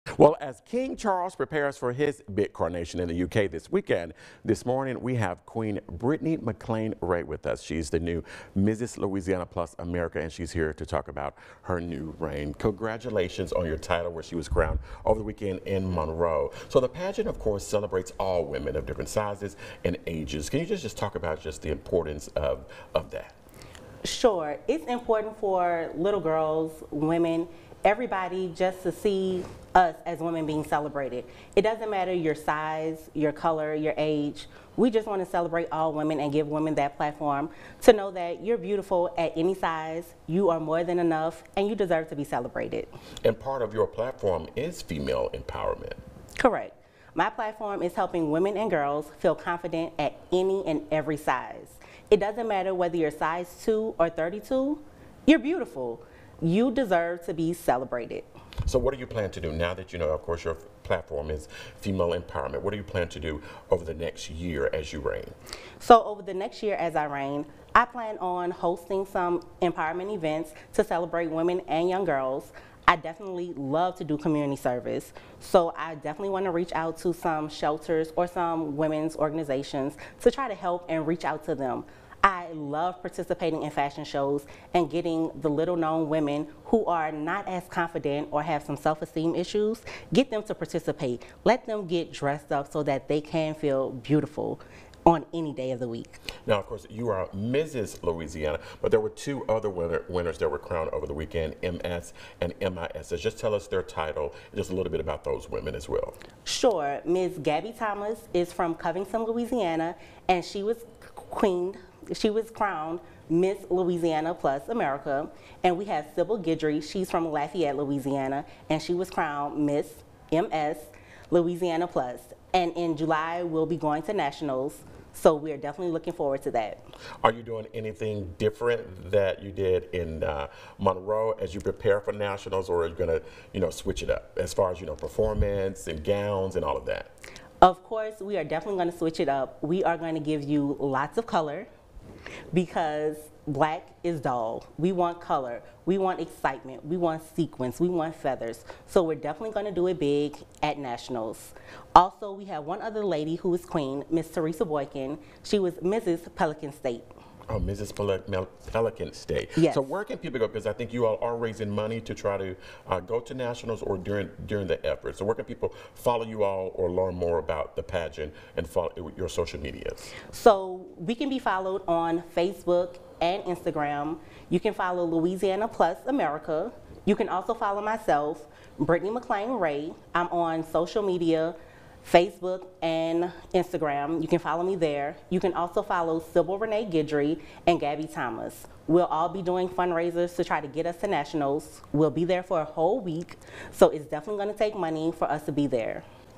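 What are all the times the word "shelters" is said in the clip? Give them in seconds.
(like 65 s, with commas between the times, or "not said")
77 s.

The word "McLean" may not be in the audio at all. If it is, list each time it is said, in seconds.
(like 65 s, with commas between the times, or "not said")
6 s, 179 s.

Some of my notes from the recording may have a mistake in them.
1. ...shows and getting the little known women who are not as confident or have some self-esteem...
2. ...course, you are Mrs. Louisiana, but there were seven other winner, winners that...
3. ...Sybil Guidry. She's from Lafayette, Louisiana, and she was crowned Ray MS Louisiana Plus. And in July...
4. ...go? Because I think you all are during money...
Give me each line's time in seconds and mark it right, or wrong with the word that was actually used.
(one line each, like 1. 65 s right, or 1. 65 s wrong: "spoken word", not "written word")
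1. 84 s right
2. 96 s wrong: "two", not "seven"
3. 116 s wrong: "Miss", not "Ray"
4. 160 s wrong: "raising", not "during".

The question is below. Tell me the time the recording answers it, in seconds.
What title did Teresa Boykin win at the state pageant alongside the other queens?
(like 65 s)
155 s.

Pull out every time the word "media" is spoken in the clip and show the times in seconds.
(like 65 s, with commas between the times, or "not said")
169 s, 181 s.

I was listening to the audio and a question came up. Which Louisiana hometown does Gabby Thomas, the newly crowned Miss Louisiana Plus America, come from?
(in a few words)
Covington.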